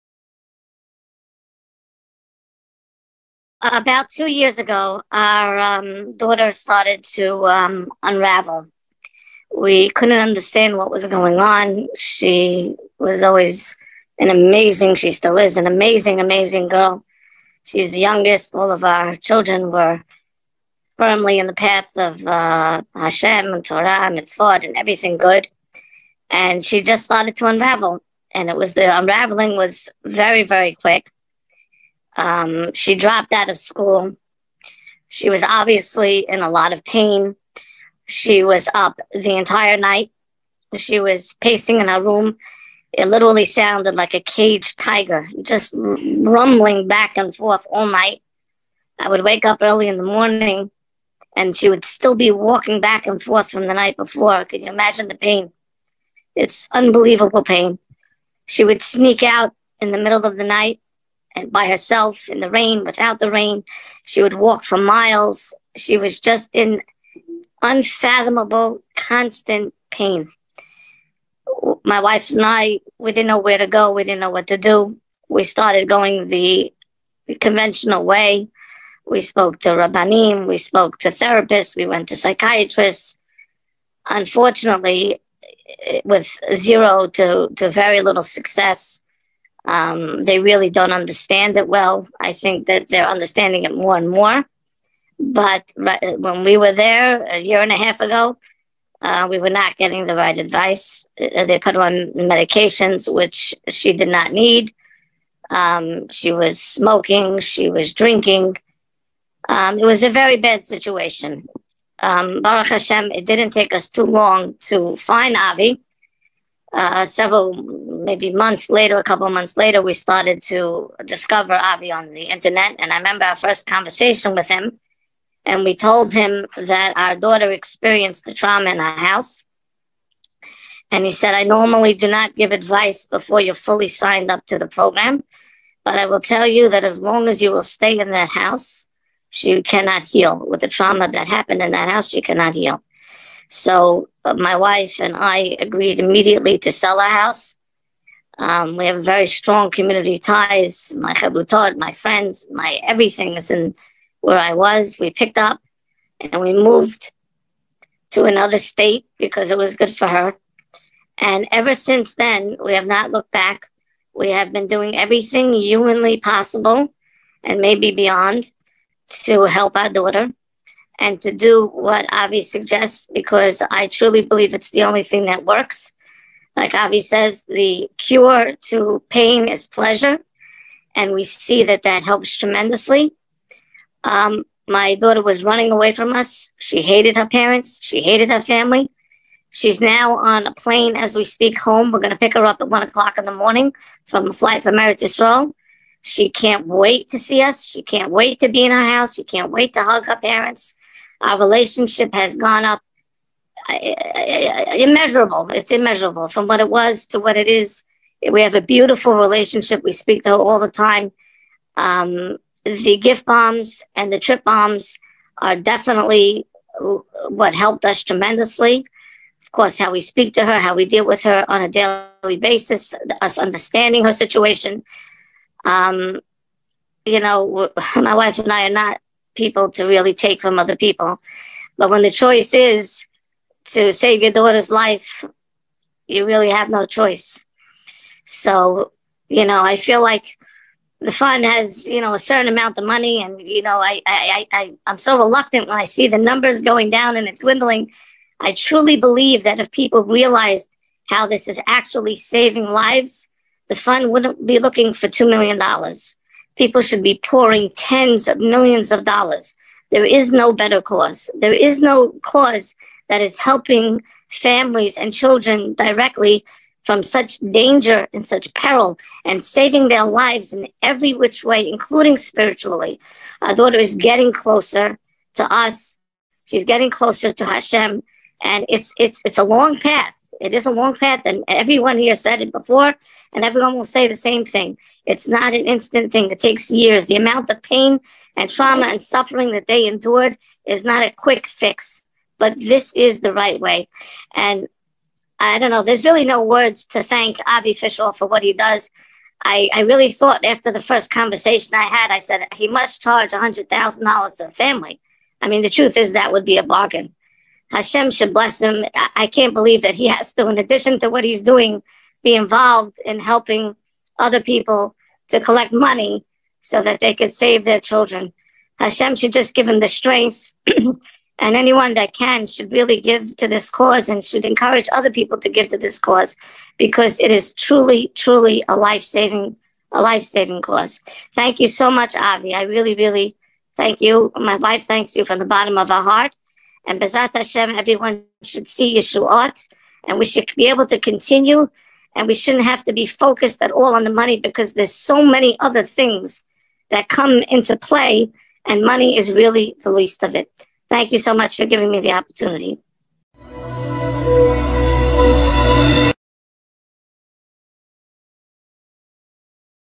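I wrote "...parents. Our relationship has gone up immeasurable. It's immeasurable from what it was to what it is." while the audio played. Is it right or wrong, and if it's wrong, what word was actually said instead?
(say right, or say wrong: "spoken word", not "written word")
right.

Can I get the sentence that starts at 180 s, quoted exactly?
And we see that that helps tremendously.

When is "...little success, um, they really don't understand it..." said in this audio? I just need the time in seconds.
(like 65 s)
88 s.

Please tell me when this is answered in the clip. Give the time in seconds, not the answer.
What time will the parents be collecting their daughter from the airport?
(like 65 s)
192 s.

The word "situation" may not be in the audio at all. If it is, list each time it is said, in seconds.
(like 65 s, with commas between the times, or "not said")
110 s, 224 s.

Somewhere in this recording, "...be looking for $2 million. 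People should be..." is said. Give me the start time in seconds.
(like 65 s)
254 s.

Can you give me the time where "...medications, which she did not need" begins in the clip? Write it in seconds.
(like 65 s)
102 s.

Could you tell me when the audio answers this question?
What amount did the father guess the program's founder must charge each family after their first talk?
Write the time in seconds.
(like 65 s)
303 s.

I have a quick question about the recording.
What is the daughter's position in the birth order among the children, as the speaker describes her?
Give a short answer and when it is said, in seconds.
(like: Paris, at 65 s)
The youngest, at 17 s.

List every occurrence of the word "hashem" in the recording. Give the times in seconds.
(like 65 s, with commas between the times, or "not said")
22 s, 112 s, 277 s, 307 s, 318 s, 337 s.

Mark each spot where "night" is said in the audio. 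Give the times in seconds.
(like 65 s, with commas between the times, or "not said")
39 s, 47 s, 53 s, 60 s.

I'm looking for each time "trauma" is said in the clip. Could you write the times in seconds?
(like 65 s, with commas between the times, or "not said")
128 s, 140 s, 288 s.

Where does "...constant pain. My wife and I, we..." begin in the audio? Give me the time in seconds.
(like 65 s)
68 s.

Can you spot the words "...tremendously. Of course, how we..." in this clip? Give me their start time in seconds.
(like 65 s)
218 s.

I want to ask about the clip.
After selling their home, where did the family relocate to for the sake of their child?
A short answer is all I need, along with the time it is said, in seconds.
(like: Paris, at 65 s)
Another state, at 158 s.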